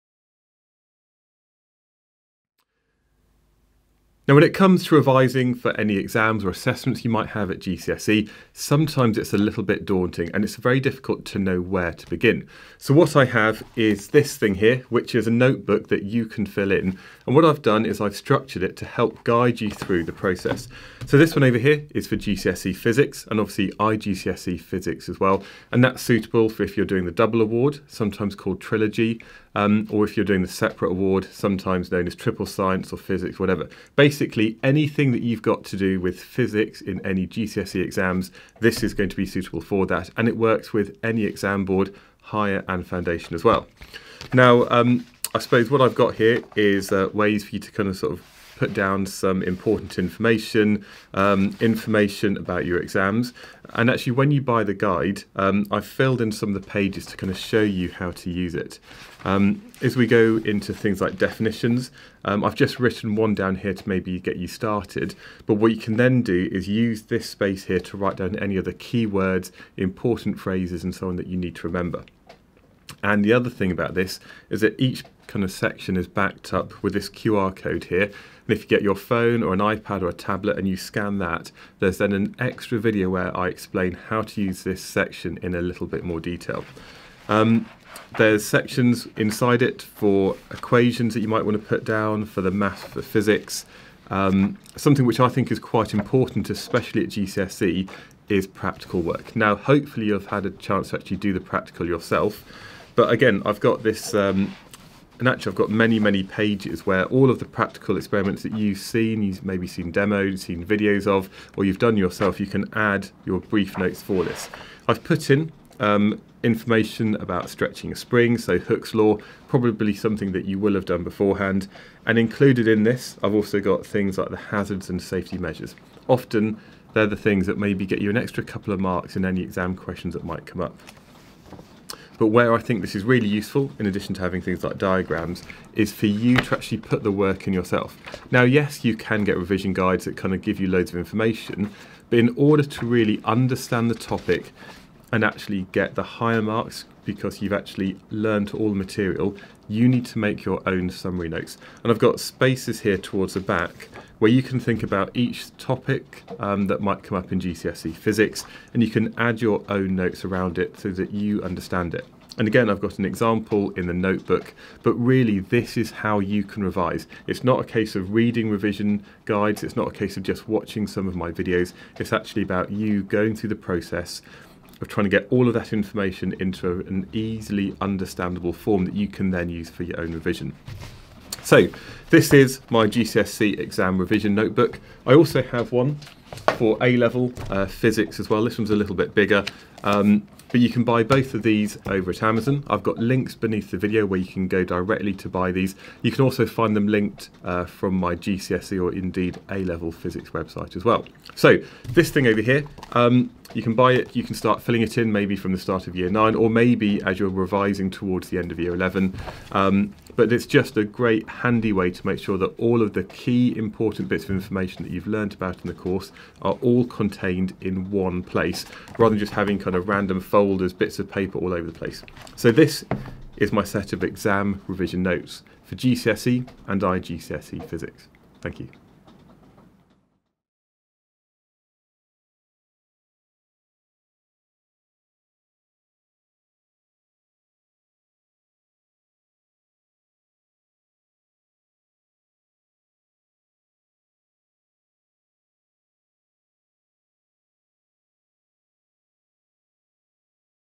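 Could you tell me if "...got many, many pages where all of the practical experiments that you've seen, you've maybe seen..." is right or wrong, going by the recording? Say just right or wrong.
right.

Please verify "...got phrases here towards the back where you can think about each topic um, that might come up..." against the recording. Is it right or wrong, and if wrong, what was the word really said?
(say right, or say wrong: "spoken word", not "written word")
wrong: "spaces", not "phrases".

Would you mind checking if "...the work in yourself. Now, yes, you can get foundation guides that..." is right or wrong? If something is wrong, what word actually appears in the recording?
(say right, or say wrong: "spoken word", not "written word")
wrong: "revision", not "foundation".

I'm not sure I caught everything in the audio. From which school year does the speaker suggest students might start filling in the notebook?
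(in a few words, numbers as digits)
Year 9.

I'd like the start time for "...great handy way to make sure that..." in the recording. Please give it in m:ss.
3:30.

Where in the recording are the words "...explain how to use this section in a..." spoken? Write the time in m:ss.
1:23.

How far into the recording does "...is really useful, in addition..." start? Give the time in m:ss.
2:12.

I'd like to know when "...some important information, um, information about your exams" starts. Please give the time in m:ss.
0:49.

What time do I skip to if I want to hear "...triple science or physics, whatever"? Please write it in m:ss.
0:32.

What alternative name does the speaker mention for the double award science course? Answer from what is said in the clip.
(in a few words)
Trilogy.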